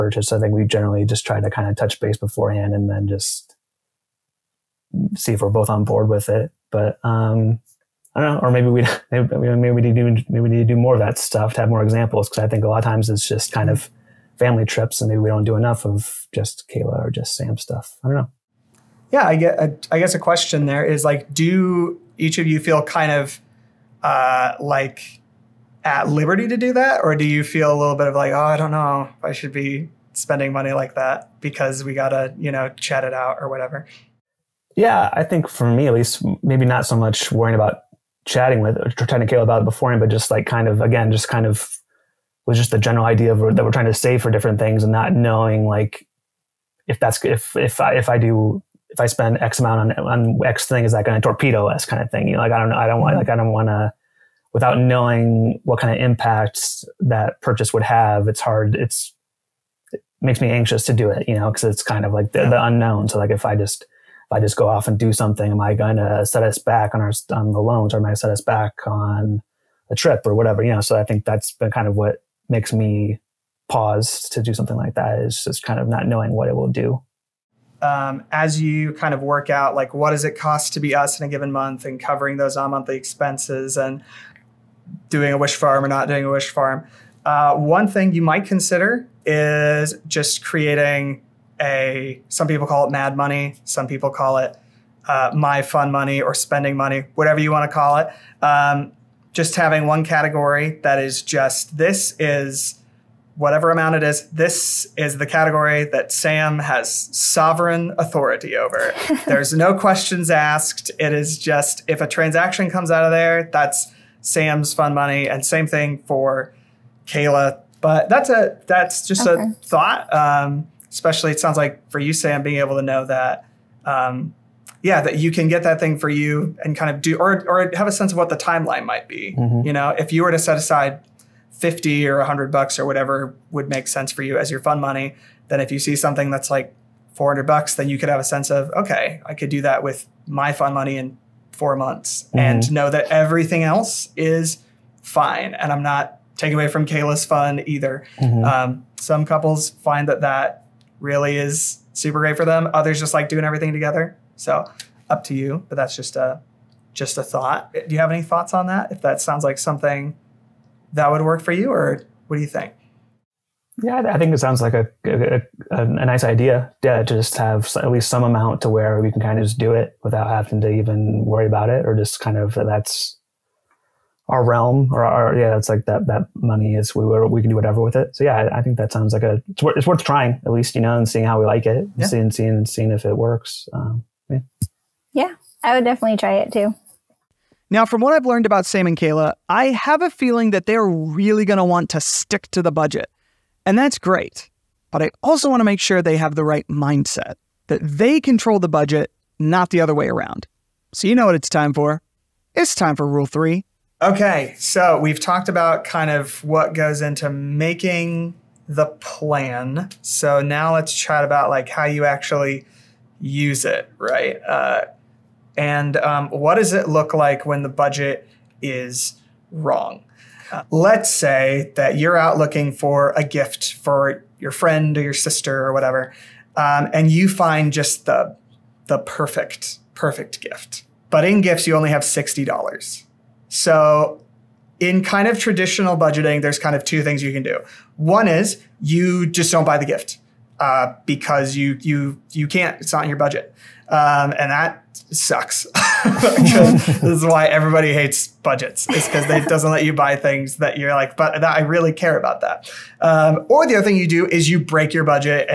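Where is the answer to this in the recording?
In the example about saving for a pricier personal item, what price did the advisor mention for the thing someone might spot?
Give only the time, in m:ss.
2:17.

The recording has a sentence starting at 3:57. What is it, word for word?
One is you just don't buy the gift uh, because you you you can't.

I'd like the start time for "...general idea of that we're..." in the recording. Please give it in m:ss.
0:42.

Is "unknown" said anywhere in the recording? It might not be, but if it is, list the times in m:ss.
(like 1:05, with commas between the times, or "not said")
1:02.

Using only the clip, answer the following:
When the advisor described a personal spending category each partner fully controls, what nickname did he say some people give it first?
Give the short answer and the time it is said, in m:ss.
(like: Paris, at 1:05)
mad money, at 1:32.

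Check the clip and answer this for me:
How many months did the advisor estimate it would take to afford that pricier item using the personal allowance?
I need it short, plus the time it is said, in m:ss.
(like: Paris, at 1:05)
4 months, at 2:21.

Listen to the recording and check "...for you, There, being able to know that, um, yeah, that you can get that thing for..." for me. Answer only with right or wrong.
wrong.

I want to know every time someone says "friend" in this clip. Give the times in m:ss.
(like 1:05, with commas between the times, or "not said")
3:44.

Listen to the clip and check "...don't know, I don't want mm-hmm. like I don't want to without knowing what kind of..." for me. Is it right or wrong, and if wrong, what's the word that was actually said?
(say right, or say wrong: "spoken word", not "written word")
right.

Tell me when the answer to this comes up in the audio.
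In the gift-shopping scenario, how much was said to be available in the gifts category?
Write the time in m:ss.
3:52.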